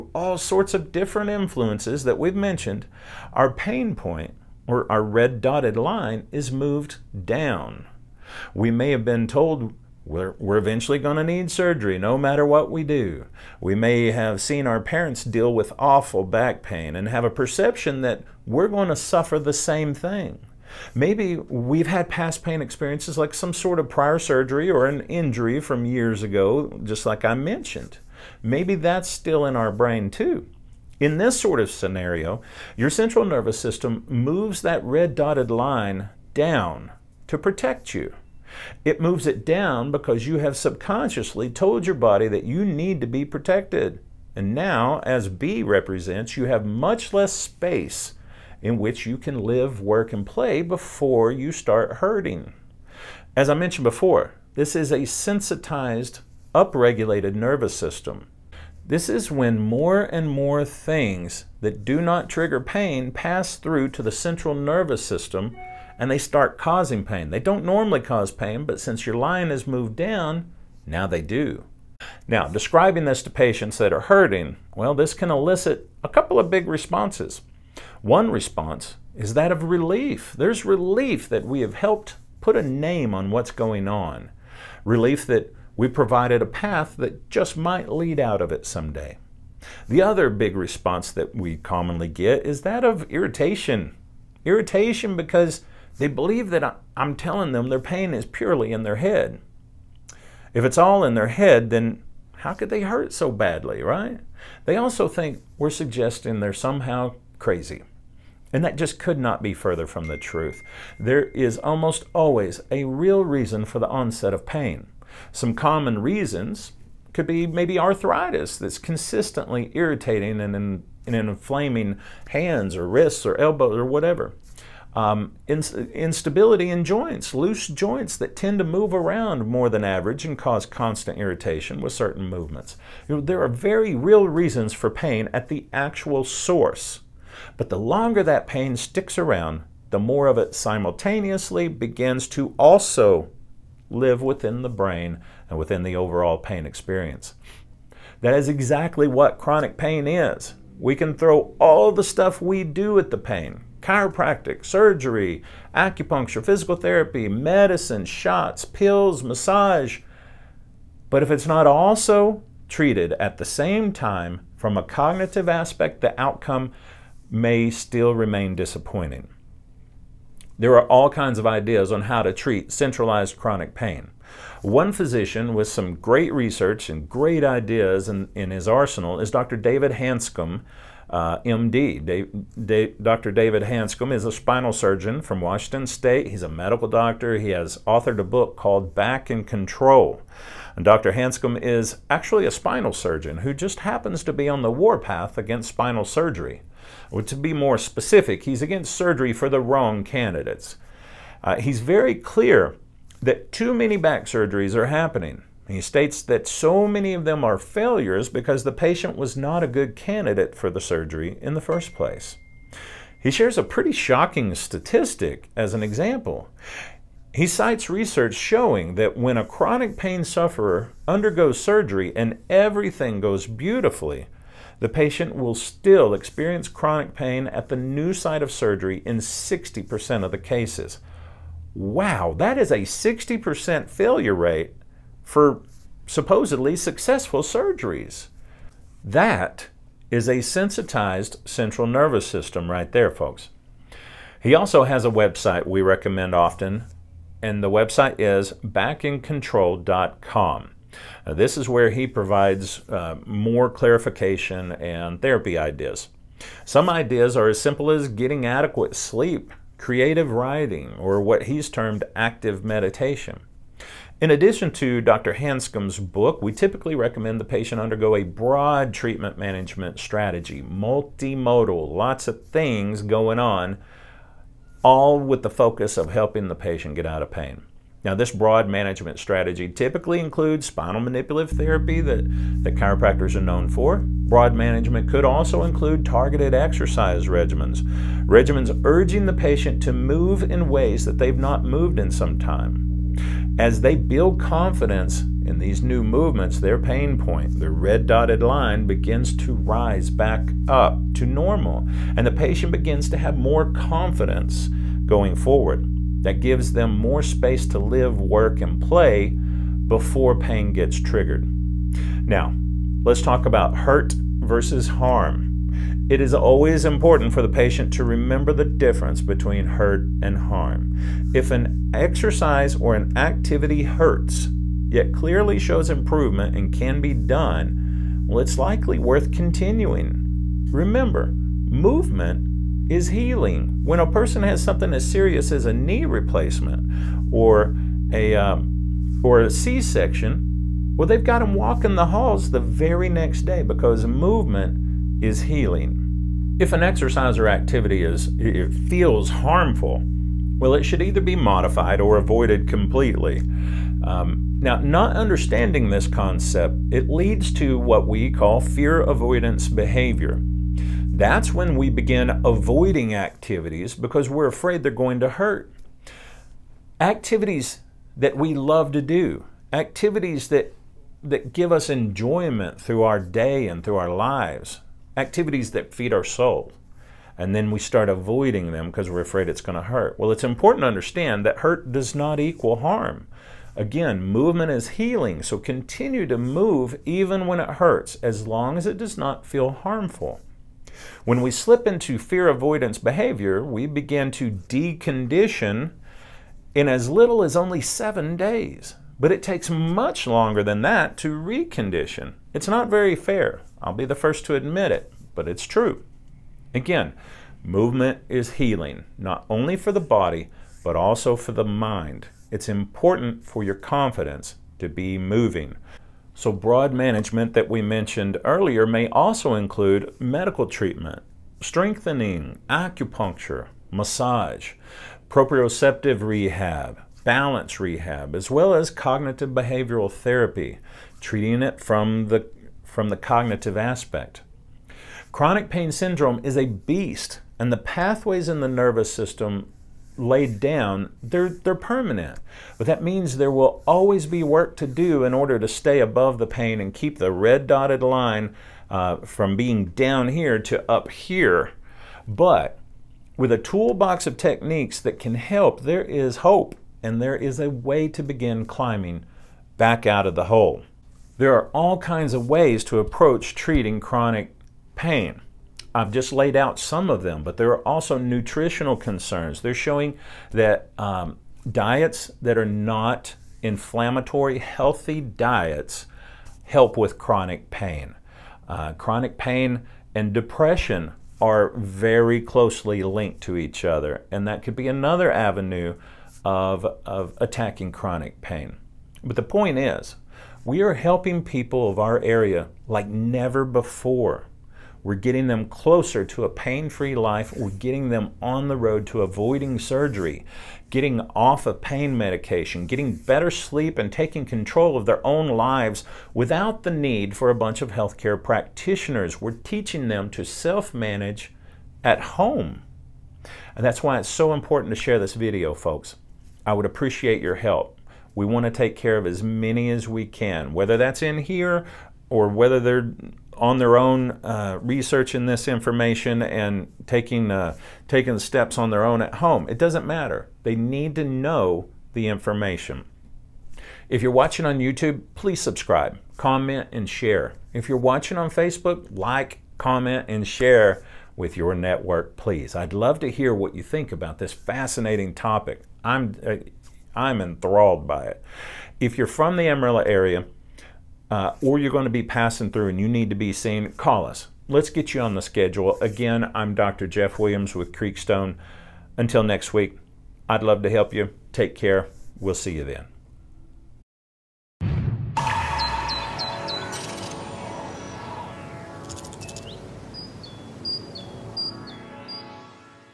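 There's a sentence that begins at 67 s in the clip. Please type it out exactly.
They don't normally cause pain, but since your line has moved down, now they do.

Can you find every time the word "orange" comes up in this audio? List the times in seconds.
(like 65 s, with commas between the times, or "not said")
not said.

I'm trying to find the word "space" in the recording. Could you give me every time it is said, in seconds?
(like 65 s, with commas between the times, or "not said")
47 s, 307 s.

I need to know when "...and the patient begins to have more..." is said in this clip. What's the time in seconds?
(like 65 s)
302 s.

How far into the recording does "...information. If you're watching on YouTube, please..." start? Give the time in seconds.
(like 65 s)
532 s.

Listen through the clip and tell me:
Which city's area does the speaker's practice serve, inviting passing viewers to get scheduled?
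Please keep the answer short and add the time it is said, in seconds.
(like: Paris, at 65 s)
Amarillo, at 549 s.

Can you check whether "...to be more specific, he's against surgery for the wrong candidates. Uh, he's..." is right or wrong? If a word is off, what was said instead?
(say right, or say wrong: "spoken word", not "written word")
right.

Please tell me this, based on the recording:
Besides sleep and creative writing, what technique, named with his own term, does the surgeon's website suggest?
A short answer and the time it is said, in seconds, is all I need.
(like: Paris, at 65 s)
active meditation, at 262 s.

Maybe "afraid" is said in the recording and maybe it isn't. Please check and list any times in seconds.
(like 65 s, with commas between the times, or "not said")
364 s, 379 s.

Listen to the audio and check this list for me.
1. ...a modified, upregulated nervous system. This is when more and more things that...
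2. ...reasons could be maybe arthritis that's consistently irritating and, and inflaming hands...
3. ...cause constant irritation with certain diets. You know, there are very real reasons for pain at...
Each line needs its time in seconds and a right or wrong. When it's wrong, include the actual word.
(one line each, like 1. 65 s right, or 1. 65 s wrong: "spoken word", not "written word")
1. 54 s wrong: "sensitized", not "modified"
2. 116 s right
3. 130 s wrong: "movements", not "diets".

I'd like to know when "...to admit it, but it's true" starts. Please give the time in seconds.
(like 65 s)
404 s.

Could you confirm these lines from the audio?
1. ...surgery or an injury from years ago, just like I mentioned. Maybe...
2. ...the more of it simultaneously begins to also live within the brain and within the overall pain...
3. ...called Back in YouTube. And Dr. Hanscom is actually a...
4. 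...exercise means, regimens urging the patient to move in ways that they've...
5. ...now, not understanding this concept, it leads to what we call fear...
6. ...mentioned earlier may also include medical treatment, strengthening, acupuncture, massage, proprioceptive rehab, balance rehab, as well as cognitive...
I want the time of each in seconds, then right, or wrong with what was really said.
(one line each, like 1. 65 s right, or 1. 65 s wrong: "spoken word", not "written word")
1. 24 s right
2. 139 s right
3. 188 s wrong: "Control", not "YouTube"
4. 286 s wrong: "regimens", not "means"
5. 354 s right
6. 417 s right.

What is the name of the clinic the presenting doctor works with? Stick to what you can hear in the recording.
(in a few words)
Creekstone.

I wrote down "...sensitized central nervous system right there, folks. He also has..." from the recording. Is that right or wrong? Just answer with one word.
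right.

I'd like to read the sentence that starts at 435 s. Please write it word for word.
Chronic pain syndrome is a beast, and the pathways in the nervous system laid down, they're, they're permanent.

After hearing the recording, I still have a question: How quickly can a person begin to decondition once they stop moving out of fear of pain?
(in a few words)
seven days.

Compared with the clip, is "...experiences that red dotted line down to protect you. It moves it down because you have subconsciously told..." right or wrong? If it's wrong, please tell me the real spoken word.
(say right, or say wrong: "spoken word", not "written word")
wrong: "moves", not "experiences".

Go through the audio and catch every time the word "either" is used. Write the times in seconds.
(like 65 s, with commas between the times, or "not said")
351 s.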